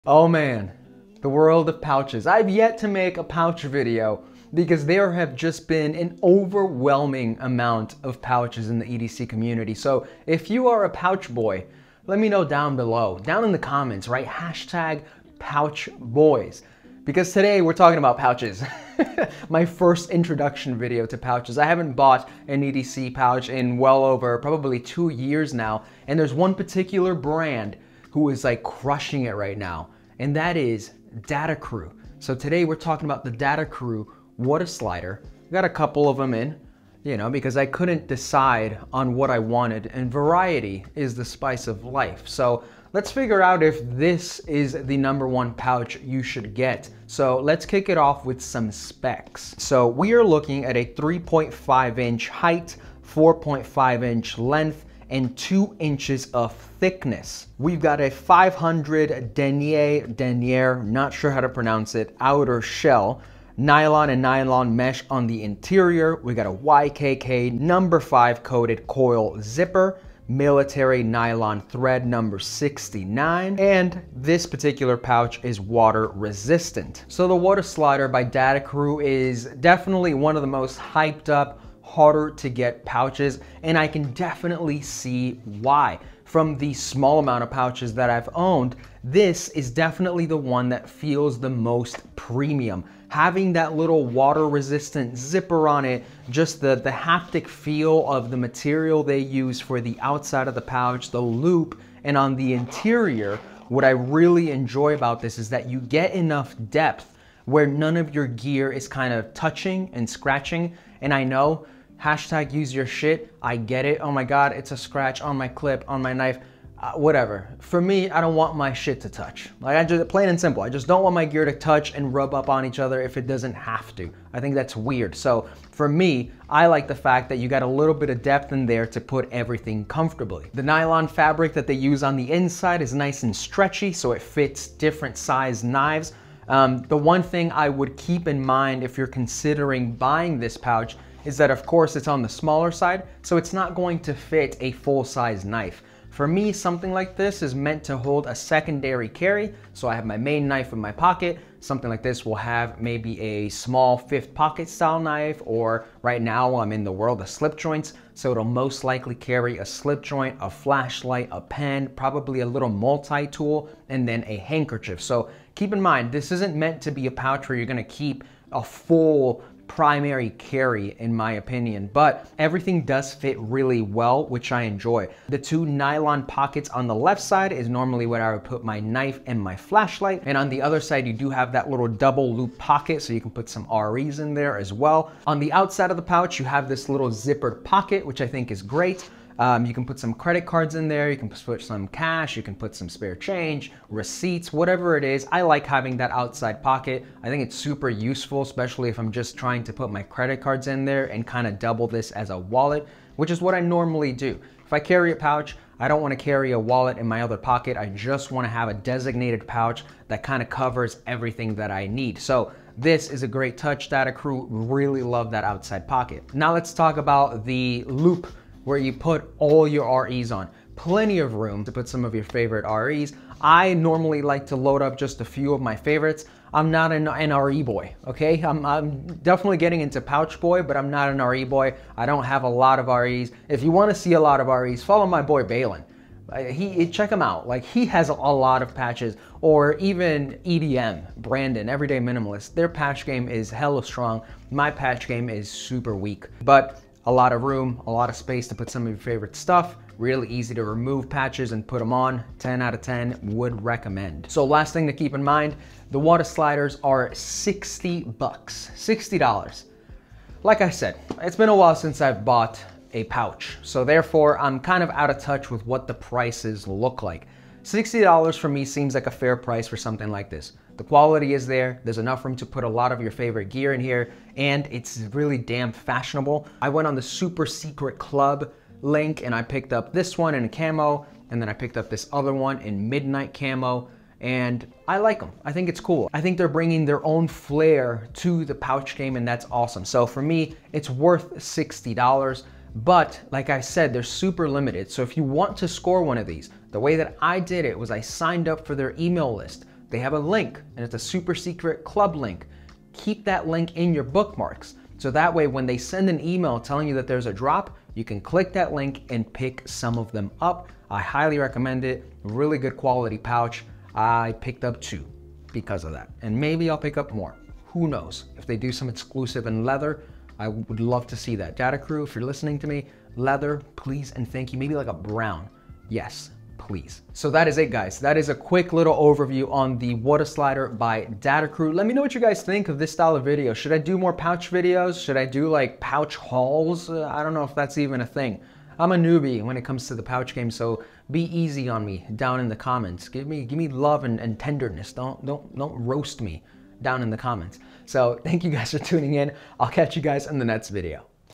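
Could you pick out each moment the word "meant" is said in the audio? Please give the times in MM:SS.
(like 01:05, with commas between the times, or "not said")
02:27, 02:46.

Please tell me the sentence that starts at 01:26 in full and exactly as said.
From the small amount of pouches that I've owned, this is definitely the one that feels the most premium.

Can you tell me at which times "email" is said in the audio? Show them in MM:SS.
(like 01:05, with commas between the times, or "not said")
04:58, 05:06.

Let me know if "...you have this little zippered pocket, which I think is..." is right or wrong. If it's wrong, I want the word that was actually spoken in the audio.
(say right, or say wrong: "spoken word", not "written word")
right.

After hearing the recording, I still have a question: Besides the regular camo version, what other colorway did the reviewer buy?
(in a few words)
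Midnight camo.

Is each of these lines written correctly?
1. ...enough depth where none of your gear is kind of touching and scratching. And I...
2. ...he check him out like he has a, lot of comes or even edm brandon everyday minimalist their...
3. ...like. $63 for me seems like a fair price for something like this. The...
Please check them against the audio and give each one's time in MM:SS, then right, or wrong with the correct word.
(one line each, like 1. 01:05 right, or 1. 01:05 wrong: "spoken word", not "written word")
1. 01:46 right
2. 03:56 wrong: "patches", not "comes"
3. 04:27 wrong: "60", not "63".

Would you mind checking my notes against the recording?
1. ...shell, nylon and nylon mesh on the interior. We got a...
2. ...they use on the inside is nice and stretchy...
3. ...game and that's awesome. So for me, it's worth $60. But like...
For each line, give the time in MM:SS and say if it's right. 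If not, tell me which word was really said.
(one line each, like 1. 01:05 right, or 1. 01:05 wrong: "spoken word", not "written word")
1. 01:02 right
2. 02:11 right
3. 04:48 right.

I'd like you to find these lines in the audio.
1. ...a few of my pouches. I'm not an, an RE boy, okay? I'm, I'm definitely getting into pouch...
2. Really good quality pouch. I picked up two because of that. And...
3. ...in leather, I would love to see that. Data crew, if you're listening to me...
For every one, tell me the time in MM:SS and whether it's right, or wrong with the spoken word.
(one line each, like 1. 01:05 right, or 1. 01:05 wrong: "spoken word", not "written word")
1. 03:45 wrong: "favorites", not "pouches"
2. 05:12 right
3. 05:19 right.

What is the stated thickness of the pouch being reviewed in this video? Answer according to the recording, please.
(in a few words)
2 inches.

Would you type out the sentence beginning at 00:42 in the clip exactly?
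So let's figure out if this is the number one pouch you should get.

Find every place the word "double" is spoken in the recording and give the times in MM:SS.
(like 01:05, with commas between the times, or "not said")
03:01, 03:21.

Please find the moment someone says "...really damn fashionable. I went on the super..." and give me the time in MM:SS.
04:35.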